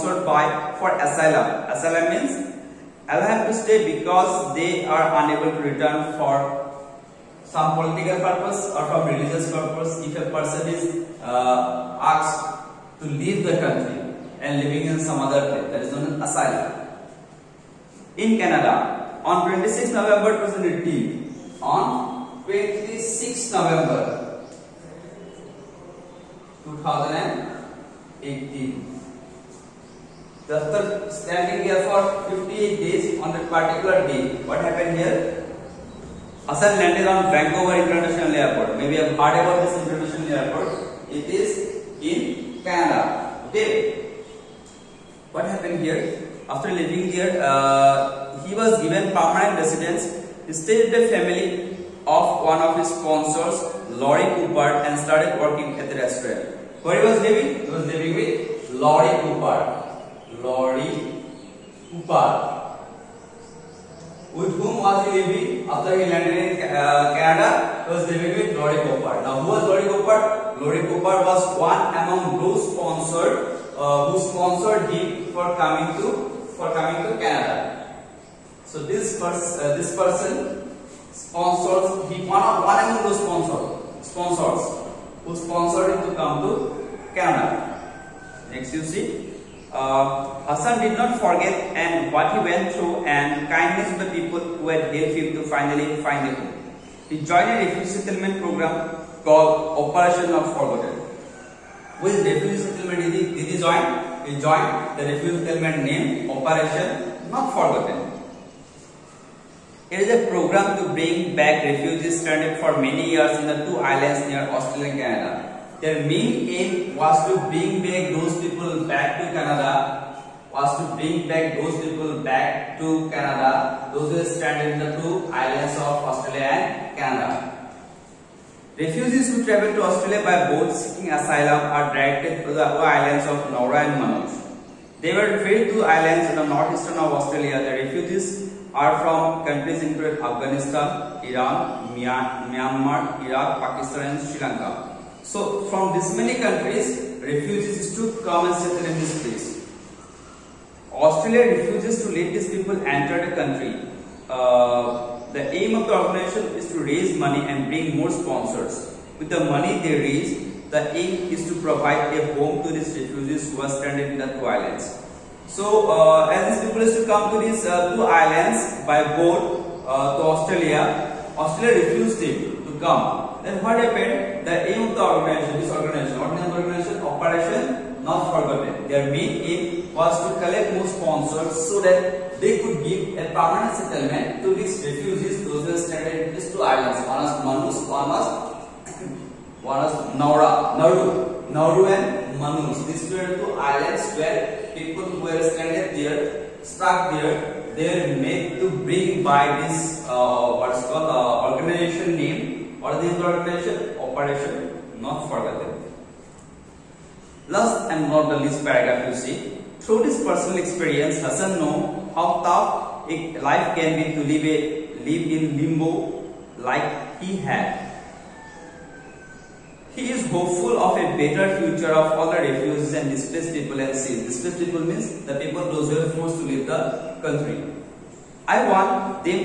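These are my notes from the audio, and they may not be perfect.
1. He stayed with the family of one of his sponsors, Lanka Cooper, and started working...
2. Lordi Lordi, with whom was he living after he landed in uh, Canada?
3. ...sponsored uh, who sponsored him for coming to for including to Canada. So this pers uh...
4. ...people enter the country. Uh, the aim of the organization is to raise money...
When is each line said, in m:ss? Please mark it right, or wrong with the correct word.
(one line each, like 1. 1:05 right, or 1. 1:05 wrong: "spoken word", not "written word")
1. 0:50 wrong: "Laurie", not "Lanka"
2. 1:00 wrong: "Cooper", not "Lordi"
3. 1:12 wrong: "coming", not "including"
4. 2:32 right.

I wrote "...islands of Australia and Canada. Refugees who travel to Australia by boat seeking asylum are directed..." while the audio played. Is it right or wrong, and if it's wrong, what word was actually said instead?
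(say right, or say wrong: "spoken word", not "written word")
right.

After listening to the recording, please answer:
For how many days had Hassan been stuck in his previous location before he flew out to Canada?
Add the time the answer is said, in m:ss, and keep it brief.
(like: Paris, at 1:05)
58, at 0:32.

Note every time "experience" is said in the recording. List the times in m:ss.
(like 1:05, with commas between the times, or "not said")
3:30.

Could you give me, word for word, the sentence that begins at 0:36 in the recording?
Hassan landed on Vancouver International Airport.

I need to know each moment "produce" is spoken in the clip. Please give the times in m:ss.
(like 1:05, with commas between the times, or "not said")
not said.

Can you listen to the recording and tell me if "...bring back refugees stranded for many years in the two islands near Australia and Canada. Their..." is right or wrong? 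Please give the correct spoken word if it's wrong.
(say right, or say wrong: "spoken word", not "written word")
right.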